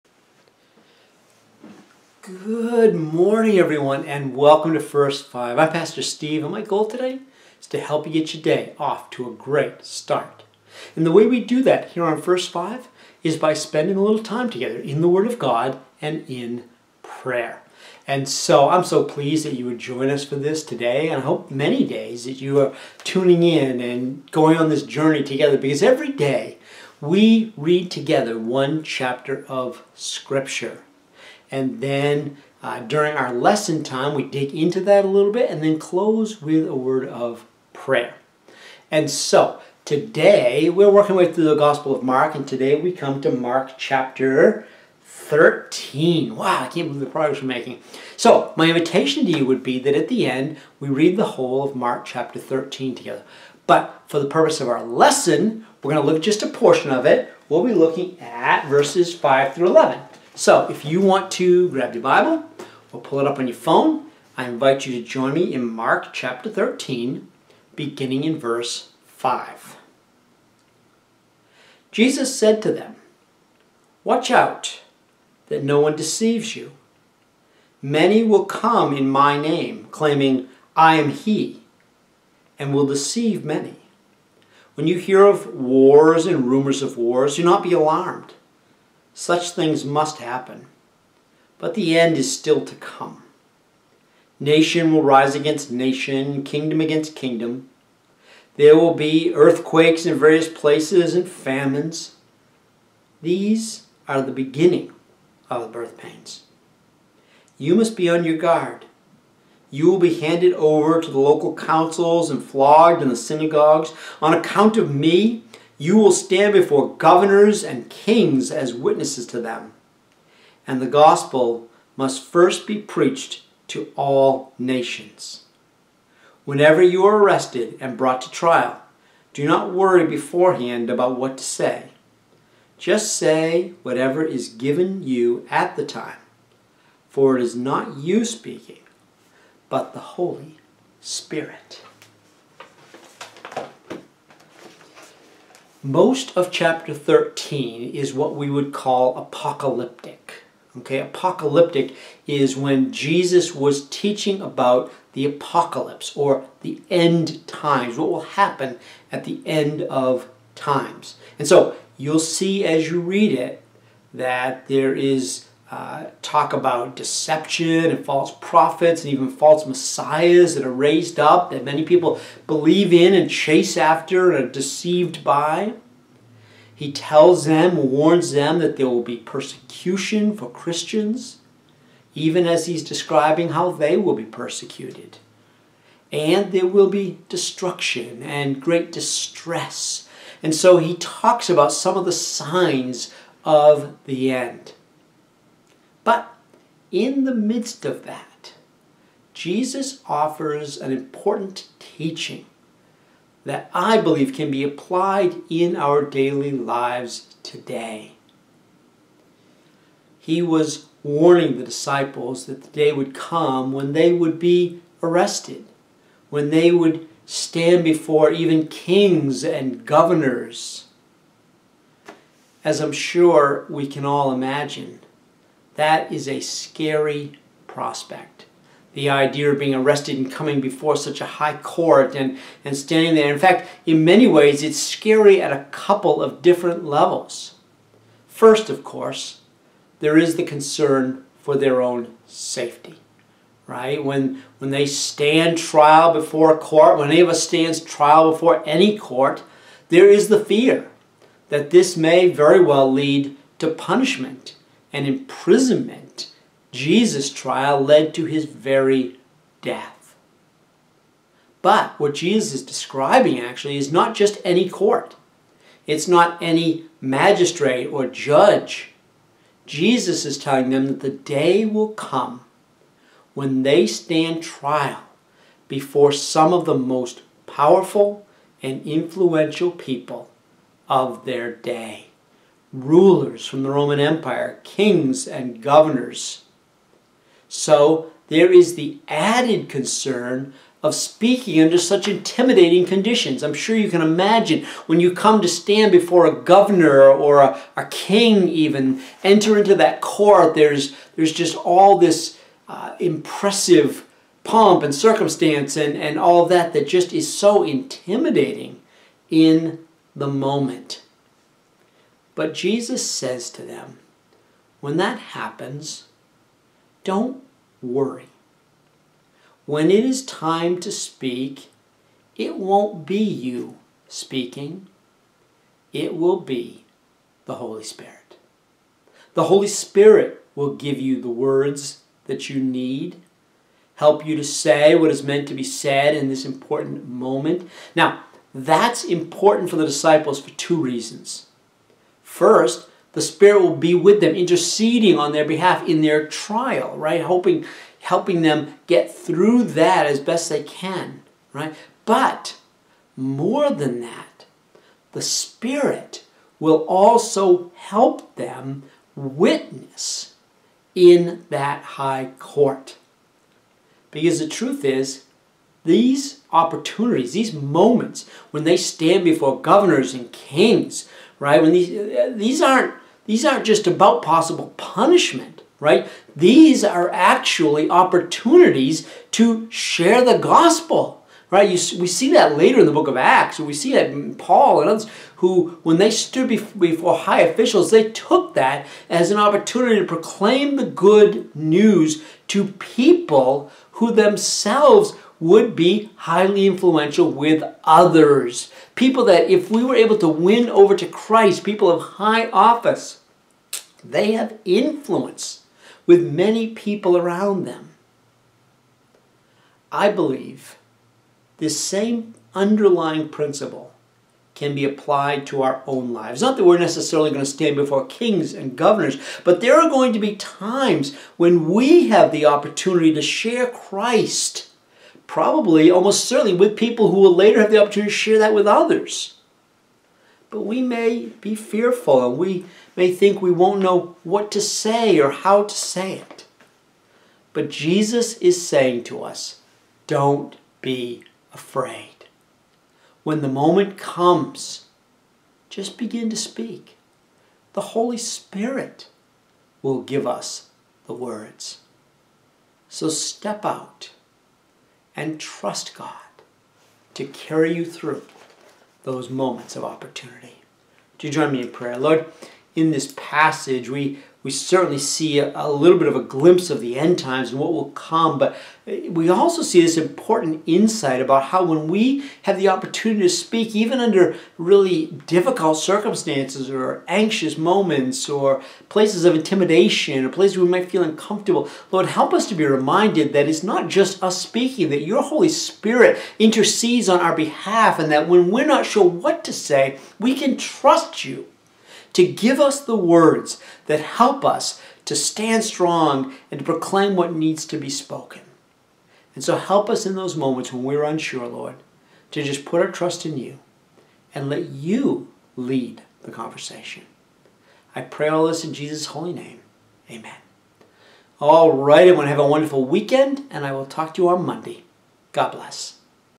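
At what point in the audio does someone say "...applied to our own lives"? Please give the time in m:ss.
6:54.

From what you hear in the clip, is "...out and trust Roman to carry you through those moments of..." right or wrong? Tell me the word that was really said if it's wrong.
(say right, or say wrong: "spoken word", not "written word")
wrong: "God", not "Roman".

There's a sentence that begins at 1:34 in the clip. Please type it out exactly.
Nation will rise against nation, kingdom against kingdom.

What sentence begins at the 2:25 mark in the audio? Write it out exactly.
Most of chapter 13 is what we would call apocalyptic.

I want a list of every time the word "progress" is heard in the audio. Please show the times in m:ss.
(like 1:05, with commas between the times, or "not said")
0:47.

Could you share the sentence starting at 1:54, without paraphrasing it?
On account of me, you will stand before governors and kings as witnesses to them.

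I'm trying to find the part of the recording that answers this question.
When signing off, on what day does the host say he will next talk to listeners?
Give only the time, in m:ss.
8:34.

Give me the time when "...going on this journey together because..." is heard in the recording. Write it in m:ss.
0:24.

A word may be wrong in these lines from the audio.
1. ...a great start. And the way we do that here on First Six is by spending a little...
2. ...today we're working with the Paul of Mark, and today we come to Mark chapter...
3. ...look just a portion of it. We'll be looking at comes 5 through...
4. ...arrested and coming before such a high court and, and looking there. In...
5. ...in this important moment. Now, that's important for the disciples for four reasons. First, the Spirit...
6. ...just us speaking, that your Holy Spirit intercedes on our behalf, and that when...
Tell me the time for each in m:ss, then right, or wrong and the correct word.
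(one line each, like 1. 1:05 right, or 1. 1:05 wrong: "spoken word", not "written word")
1. 0:09 wrong: "Five", not "Six"
2. 0:39 wrong: "Gospel", not "Paul"
3. 0:56 wrong: "verses", not "comes"
4. 3:49 wrong: "standing", not "looking"
5. 5:36 wrong: "two", not "four"
6. 8:03 right.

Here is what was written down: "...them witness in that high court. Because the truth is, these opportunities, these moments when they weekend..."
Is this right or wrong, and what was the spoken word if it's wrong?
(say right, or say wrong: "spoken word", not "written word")
wrong: "stand", not "weekend".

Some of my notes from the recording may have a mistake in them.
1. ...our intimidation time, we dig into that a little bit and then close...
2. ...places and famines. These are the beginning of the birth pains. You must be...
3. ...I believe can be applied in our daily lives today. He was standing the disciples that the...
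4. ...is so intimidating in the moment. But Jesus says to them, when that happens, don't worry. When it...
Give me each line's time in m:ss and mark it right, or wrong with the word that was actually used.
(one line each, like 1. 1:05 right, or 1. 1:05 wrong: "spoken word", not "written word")
1. 0:33 wrong: "lesson", not "intimidation"
2. 1:40 right
3. 3:23 wrong: "warning", not "standing"
4. 5:07 right.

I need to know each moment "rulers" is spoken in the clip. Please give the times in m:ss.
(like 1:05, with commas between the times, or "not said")
4:42.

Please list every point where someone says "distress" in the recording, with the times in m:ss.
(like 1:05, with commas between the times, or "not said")
3:08.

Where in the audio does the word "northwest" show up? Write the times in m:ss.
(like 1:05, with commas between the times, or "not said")
not said.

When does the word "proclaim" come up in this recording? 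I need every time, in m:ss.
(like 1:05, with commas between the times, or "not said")
6:30, 8:16.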